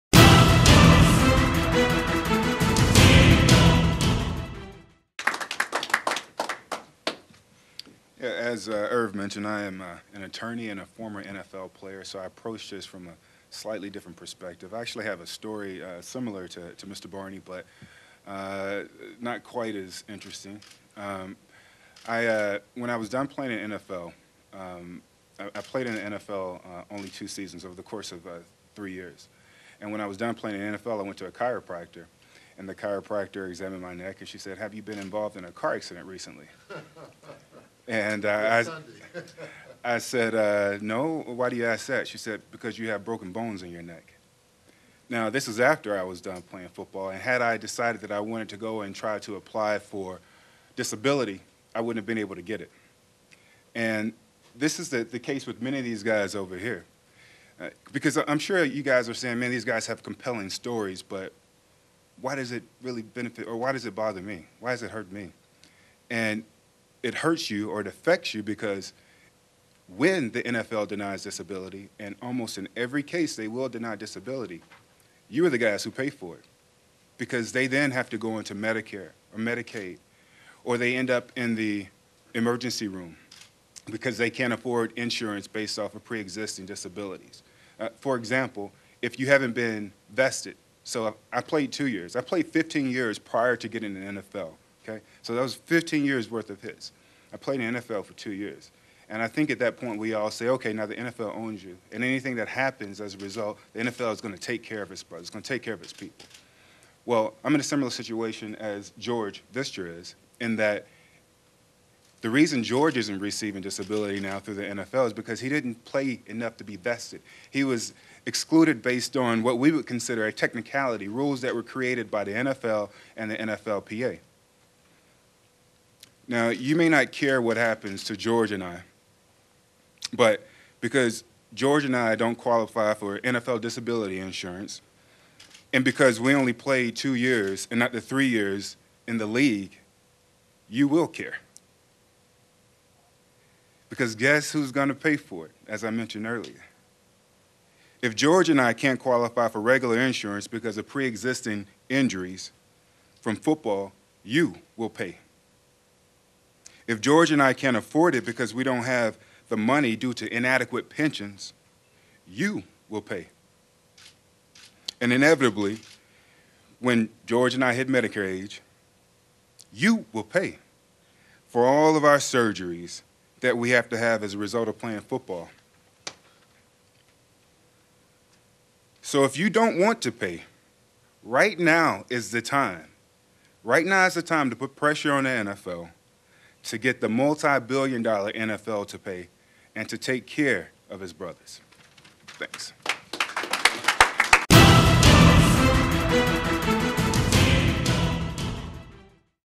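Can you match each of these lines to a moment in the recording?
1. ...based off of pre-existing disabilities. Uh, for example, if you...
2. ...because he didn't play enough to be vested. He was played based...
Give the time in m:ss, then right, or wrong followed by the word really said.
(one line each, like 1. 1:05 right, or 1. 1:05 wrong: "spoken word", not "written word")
1. 1:25 right
2. 1:55 wrong: "excluded", not "played".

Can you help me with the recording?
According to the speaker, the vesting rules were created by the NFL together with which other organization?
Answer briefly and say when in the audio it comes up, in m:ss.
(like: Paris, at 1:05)
NFLPA, at 2:03.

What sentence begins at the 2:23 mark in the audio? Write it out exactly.
Because guess who's going to pay for it, as I mentioned earlier?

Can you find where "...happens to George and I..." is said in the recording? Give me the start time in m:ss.
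2:07.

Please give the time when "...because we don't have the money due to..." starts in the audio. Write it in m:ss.
2:38.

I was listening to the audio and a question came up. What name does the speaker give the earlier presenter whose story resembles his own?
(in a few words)
Mr. Barney.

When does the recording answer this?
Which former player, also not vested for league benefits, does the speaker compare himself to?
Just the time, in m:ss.
1:48.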